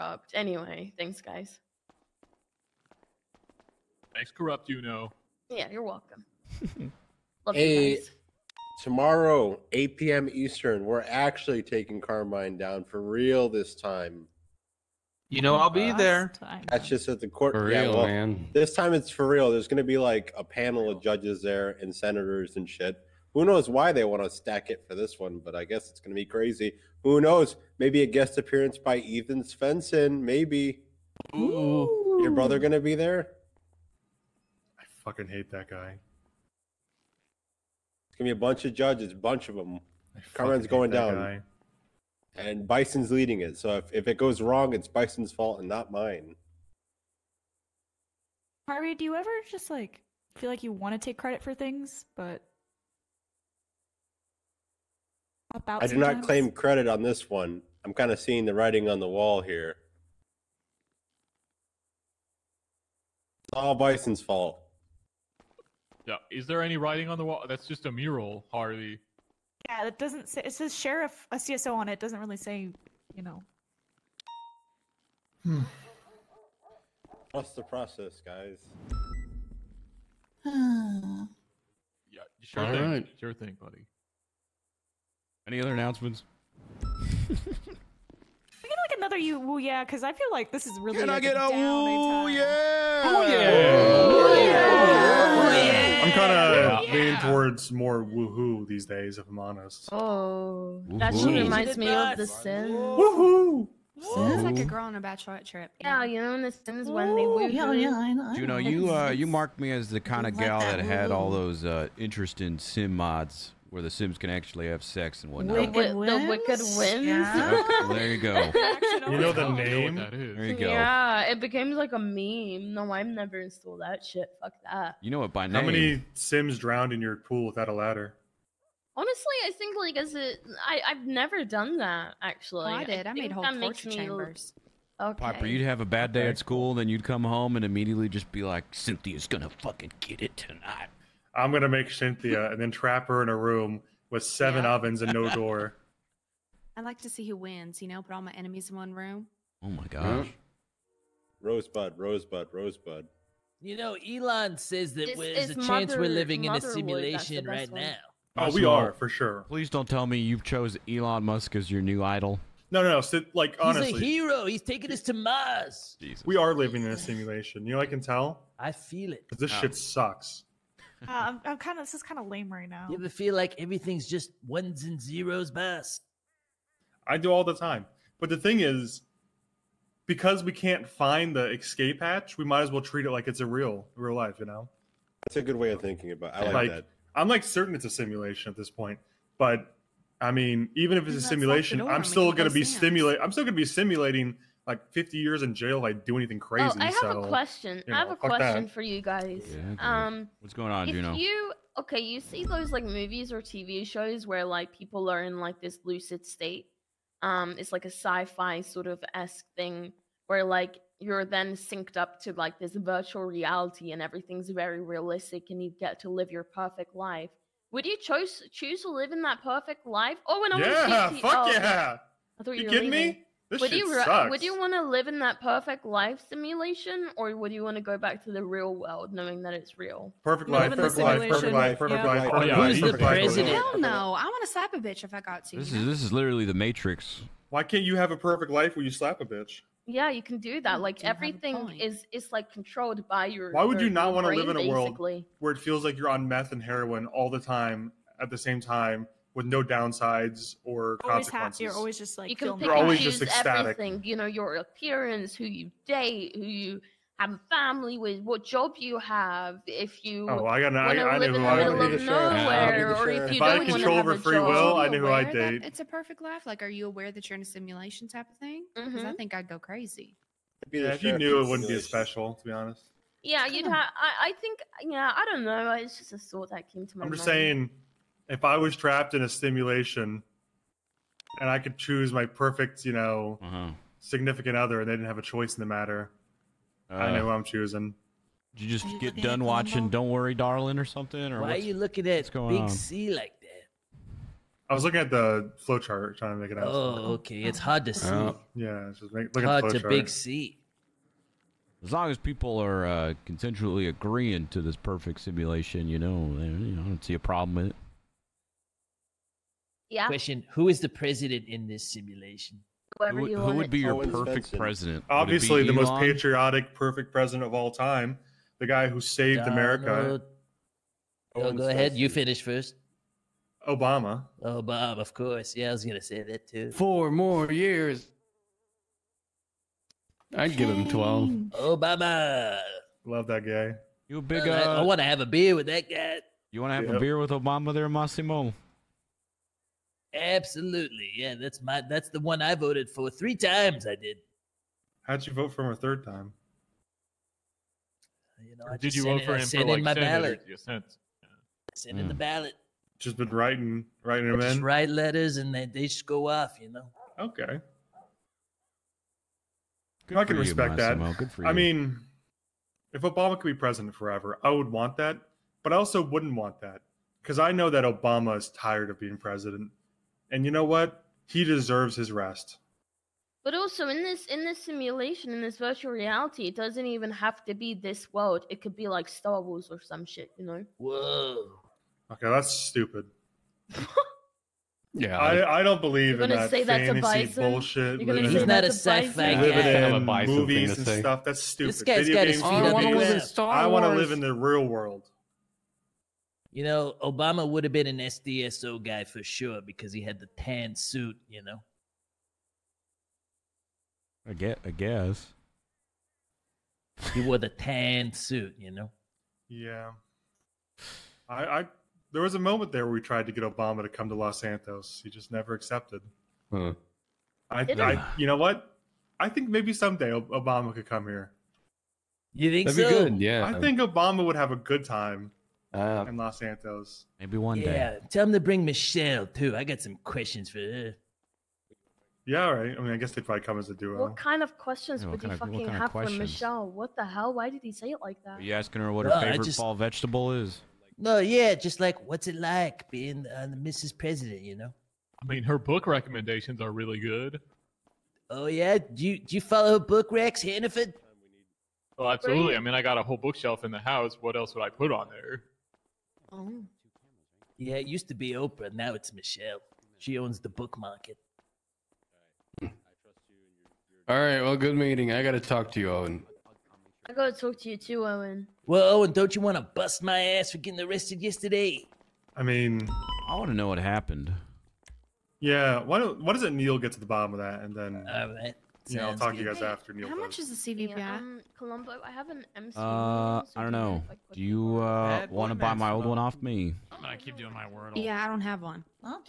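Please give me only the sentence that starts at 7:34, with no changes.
What else would I put on there?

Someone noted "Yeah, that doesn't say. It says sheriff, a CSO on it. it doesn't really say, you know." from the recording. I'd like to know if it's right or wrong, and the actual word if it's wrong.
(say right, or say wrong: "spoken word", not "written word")
right.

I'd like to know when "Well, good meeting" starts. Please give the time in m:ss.
7:44.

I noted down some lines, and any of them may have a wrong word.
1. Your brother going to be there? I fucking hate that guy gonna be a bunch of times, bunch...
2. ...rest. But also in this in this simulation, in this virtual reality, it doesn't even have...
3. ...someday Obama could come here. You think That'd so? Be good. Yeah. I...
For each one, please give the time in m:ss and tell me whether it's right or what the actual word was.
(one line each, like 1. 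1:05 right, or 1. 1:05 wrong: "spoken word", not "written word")
1. 0:32 wrong: "judges", not "times"
2. 6:12 right
3. 6:59 right.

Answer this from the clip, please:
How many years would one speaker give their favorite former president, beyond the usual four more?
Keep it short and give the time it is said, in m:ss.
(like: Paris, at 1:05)
12, at 5:30.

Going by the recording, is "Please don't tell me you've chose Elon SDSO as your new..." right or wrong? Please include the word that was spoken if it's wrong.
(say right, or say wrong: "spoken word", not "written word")
wrong: "Musk", not "SDSO".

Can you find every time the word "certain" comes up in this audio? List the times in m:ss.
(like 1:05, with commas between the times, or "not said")
3:07.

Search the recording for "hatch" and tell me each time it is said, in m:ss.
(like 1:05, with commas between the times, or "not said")
3:02.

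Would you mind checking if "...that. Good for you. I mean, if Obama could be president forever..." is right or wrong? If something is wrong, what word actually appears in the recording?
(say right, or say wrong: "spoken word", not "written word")
right.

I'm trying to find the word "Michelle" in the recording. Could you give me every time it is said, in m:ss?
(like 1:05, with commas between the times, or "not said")
7:08, 7:16, 7:39.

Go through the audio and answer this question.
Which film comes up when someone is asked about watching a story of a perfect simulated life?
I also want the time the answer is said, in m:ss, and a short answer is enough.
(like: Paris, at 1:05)
Don't Worry, Darling, at 4:49.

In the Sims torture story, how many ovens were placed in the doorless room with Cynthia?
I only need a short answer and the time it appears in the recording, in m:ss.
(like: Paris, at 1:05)
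7, at 2:24.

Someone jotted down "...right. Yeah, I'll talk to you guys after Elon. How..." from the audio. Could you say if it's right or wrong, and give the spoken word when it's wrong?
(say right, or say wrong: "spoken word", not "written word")
wrong: "Neil", not "Elon".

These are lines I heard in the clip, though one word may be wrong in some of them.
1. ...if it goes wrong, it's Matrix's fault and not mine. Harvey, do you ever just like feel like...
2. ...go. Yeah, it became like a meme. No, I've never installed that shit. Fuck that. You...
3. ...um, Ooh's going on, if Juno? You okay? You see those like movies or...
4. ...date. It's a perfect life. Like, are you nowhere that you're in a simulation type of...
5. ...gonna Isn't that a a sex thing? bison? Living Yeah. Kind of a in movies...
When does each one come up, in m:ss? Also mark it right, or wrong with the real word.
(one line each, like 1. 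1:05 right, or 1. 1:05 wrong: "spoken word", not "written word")
1. 0:43 wrong: "Bison", not "Matrix"
2. 2:00 right
3. 3:20 wrong: "What", not "Ooh"
4. 4:25 wrong: "aware", not "nowhere"
5. 6:28 right.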